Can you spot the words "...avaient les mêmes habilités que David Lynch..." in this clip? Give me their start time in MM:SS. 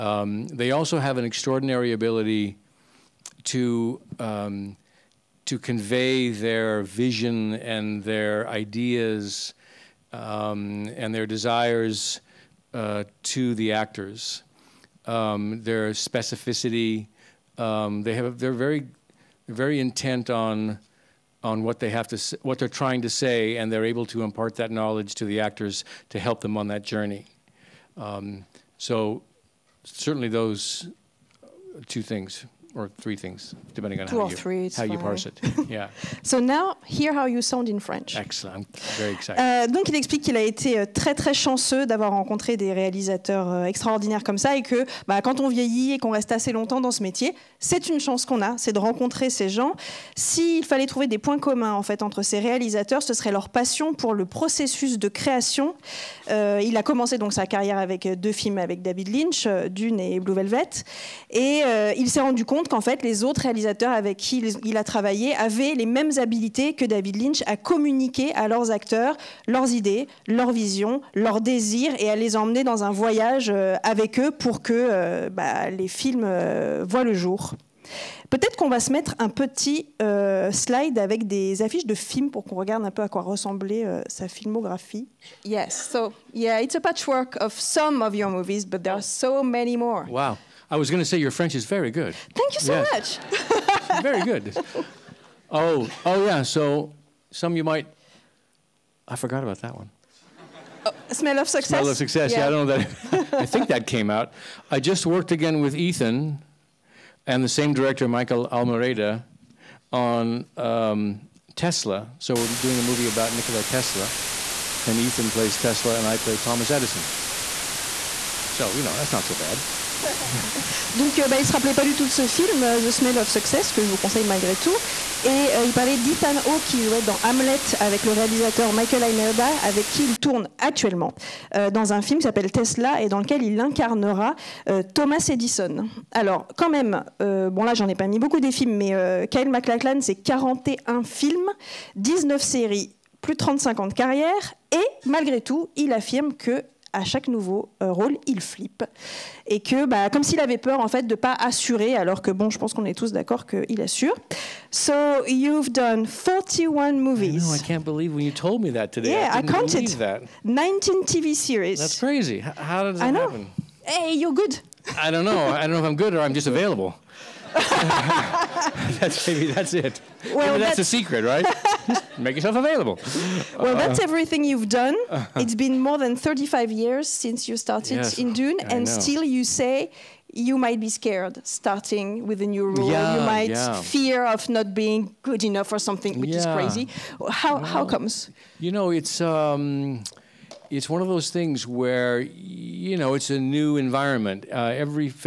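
01:05.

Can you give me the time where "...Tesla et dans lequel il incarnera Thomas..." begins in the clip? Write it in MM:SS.
02:12.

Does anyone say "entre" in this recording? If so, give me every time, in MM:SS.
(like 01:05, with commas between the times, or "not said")
00:52.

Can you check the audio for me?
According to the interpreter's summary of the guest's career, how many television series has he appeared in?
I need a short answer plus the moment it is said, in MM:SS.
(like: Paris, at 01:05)
19, at 02:21.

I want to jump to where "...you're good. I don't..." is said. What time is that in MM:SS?
02:44.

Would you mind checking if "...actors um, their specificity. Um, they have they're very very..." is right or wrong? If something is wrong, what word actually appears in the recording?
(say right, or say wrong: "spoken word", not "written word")
right.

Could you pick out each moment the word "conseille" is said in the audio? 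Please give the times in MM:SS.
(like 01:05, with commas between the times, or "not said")
02:03.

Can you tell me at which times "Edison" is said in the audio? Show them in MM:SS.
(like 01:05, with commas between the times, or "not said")
01:56, 02:15.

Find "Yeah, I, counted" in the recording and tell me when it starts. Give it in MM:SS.
02:39.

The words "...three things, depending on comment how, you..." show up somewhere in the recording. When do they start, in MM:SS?
00:32.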